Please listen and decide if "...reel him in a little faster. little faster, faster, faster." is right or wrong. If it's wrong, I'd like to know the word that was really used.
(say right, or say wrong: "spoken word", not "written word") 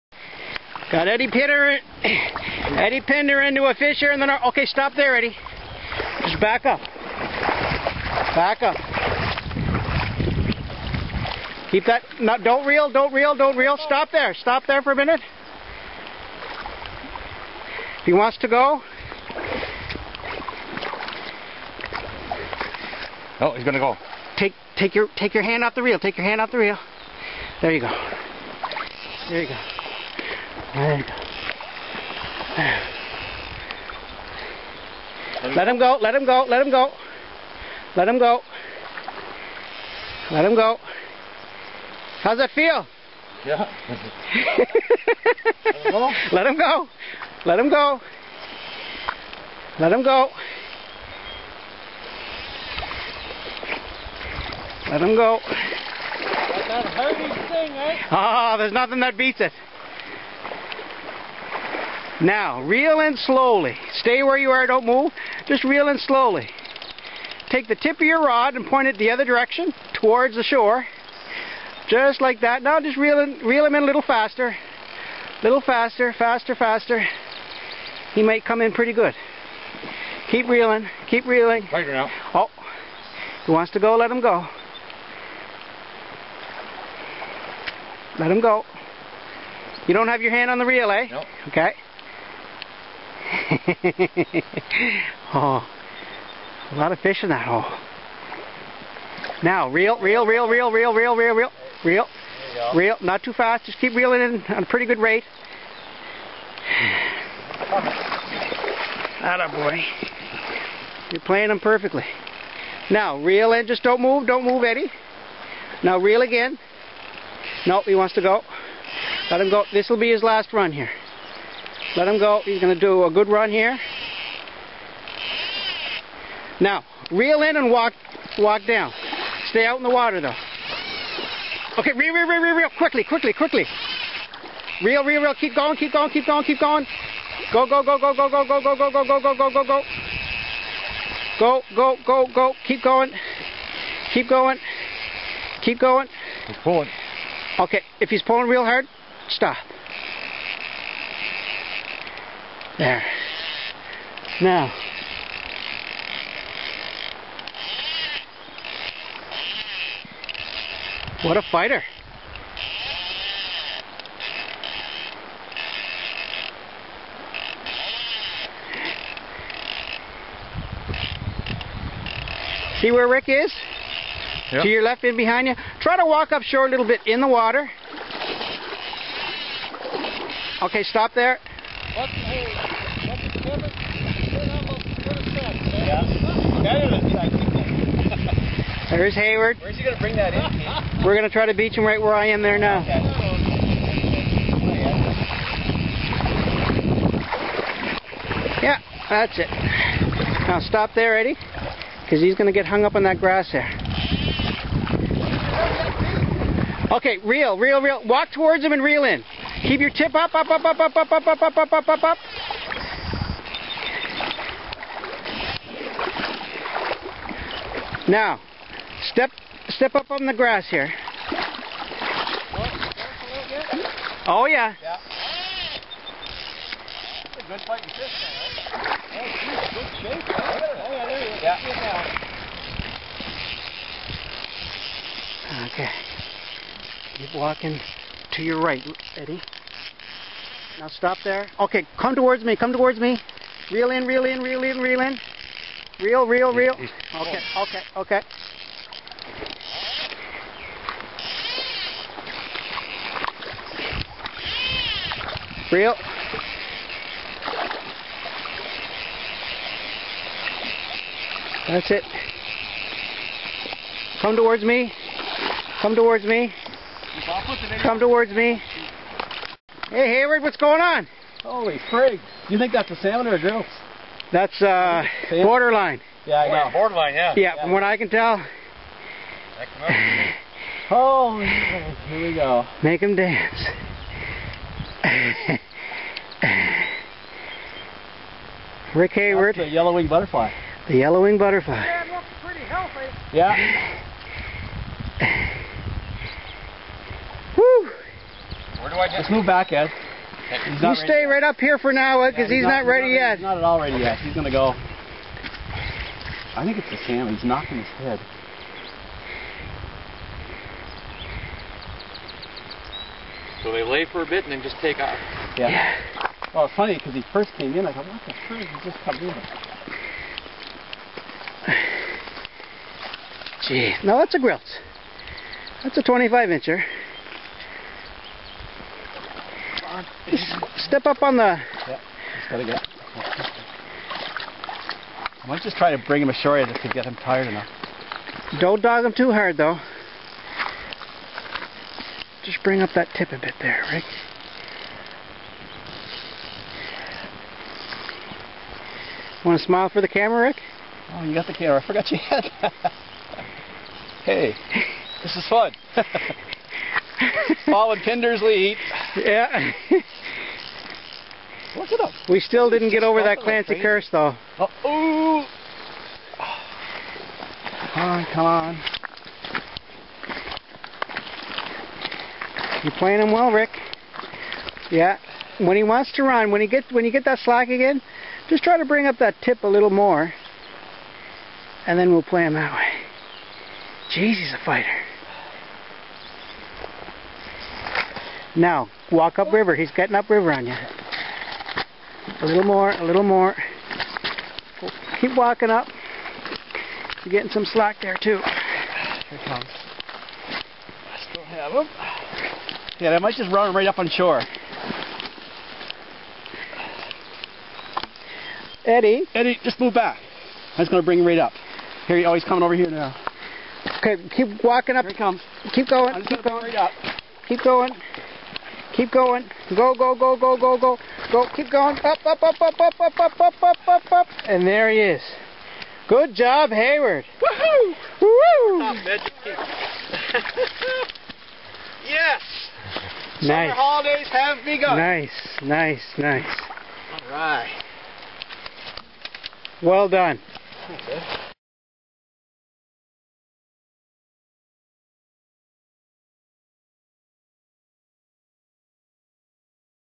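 right.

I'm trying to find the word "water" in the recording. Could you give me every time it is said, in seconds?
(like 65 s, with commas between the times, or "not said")
129 s, 177 s.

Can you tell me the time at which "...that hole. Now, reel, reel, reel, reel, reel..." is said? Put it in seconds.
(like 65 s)
97 s.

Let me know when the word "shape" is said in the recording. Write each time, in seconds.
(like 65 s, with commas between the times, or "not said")
229 s.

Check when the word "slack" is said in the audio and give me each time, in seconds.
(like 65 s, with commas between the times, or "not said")
377 s, 397 s.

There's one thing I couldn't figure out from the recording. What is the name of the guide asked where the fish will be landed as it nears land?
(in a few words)
Pete.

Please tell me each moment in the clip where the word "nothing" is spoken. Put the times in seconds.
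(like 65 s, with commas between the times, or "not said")
58 s.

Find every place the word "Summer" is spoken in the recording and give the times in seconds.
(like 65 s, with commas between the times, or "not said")
433 s.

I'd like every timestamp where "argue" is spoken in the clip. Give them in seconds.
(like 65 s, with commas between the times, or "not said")
not said.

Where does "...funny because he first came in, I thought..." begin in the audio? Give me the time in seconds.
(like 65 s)
316 s.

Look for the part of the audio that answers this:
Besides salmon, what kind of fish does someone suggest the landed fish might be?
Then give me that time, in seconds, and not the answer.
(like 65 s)
273 s.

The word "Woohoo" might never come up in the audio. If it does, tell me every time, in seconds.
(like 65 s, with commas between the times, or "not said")
427 s.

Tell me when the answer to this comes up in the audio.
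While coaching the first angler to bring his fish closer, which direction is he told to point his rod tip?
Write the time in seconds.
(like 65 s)
69 s.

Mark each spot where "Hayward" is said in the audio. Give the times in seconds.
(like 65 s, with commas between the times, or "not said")
189 s, 270 s, 289 s, 426 s.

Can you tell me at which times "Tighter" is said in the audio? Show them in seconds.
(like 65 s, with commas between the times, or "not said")
81 s.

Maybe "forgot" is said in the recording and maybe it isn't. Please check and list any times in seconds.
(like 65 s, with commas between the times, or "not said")
351 s.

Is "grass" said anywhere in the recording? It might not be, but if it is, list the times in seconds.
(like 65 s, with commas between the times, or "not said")
203 s, 220 s.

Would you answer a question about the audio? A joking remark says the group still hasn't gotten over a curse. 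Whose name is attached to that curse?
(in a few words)
Clancy.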